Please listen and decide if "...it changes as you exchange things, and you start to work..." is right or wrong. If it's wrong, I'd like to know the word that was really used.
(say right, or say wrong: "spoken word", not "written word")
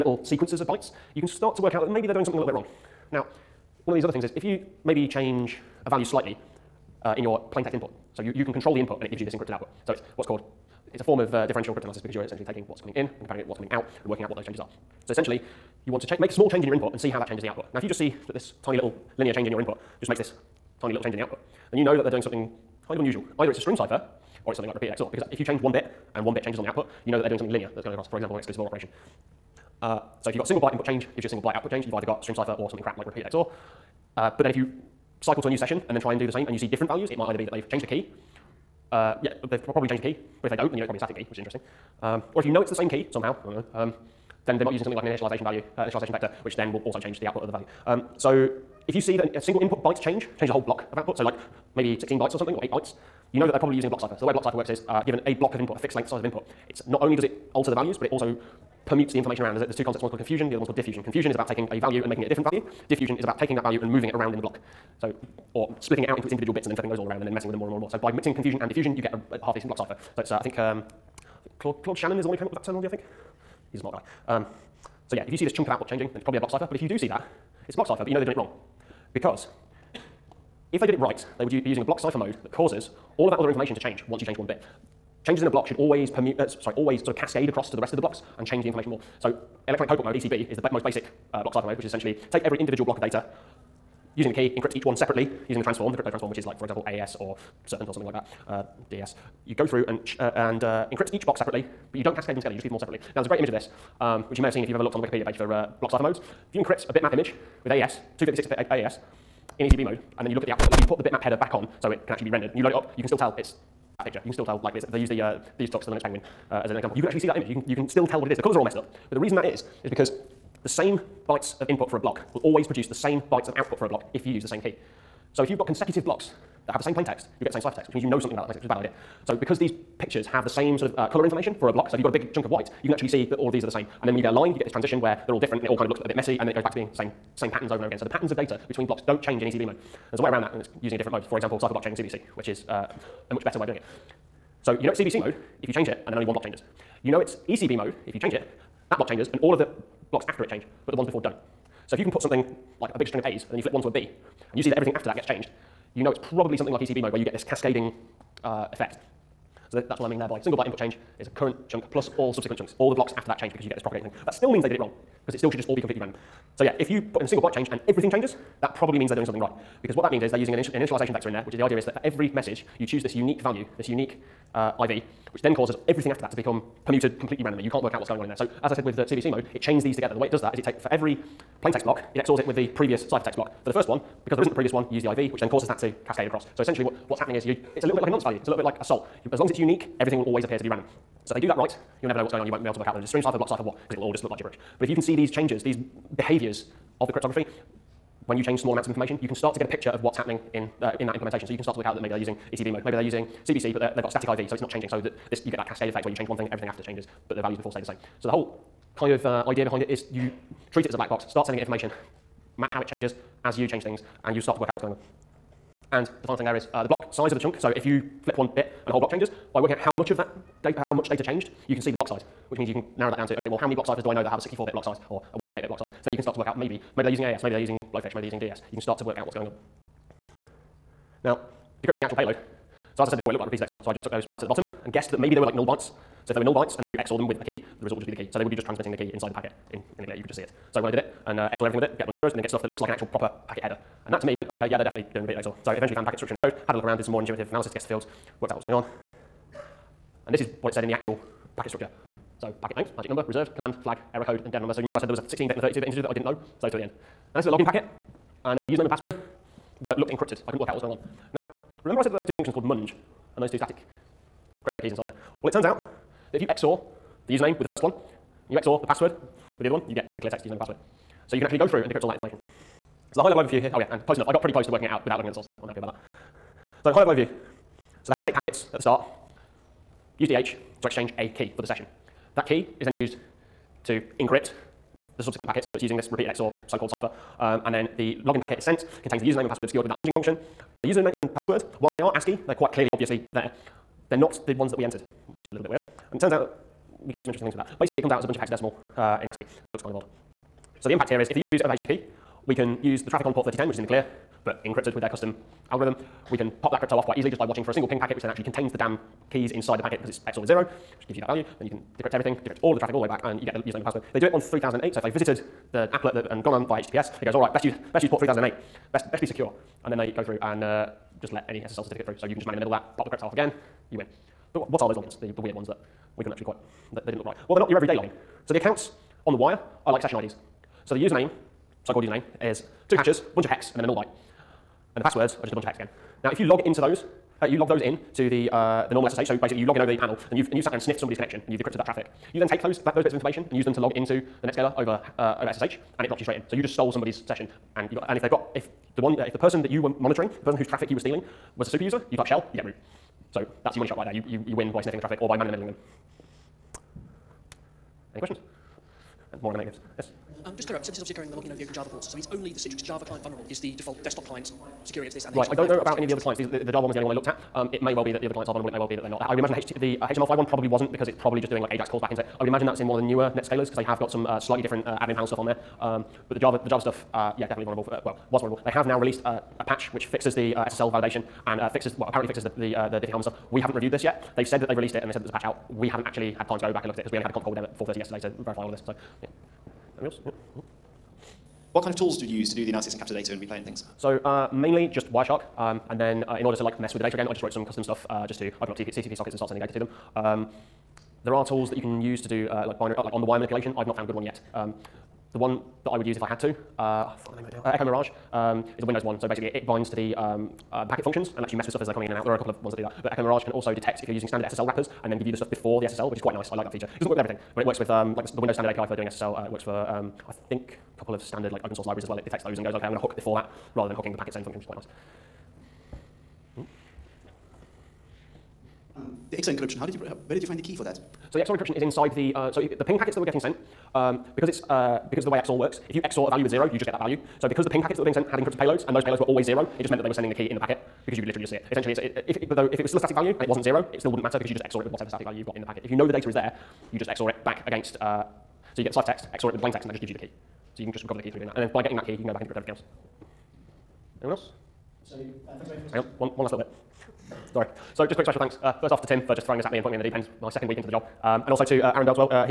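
wrong: "change", not "exchange".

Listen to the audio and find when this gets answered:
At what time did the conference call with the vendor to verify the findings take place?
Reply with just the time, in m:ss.
6:27.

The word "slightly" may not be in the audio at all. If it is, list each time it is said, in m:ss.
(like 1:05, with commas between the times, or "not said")
0:06, 6:14.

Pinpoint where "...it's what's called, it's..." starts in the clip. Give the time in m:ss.
0:09.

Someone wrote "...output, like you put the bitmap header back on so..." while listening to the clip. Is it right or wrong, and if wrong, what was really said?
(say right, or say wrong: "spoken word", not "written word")
right.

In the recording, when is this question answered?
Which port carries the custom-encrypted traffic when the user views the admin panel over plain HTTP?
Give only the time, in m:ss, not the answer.
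5:03.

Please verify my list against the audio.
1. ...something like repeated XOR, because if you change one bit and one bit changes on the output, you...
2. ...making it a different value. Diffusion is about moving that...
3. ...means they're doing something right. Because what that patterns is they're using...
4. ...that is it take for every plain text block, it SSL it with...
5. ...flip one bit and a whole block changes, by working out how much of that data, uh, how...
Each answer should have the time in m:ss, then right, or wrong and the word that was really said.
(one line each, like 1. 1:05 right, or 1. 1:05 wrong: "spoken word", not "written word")
1. 0:24 right
2. 1:02 wrong: "taking", not "moving"
3. 2:48 wrong: "means", not "patterns"
4. 3:00 wrong: "XORs", not "SSL"
5. 3:38 right.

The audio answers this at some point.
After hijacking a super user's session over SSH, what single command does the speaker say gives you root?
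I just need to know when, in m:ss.
5:52.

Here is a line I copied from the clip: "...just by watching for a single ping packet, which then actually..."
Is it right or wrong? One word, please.
right.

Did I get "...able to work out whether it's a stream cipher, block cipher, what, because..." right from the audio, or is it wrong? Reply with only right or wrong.
right.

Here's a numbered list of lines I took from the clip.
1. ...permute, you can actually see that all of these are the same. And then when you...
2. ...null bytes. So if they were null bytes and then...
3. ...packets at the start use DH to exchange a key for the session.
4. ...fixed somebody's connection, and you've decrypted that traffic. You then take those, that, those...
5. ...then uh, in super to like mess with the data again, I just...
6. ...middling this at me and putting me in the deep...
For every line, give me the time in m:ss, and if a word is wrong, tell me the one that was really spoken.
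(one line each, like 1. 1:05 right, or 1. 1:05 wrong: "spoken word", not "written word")
1. 2:12 wrong: "white", not "permute"
2. 3:55 right
3. 4:38 right
4. 5:40 wrong: "sniffed", not "fixed"
5. 6:35 wrong: "order", not "super"
6. 7:39 wrong: "throwing", not "middling".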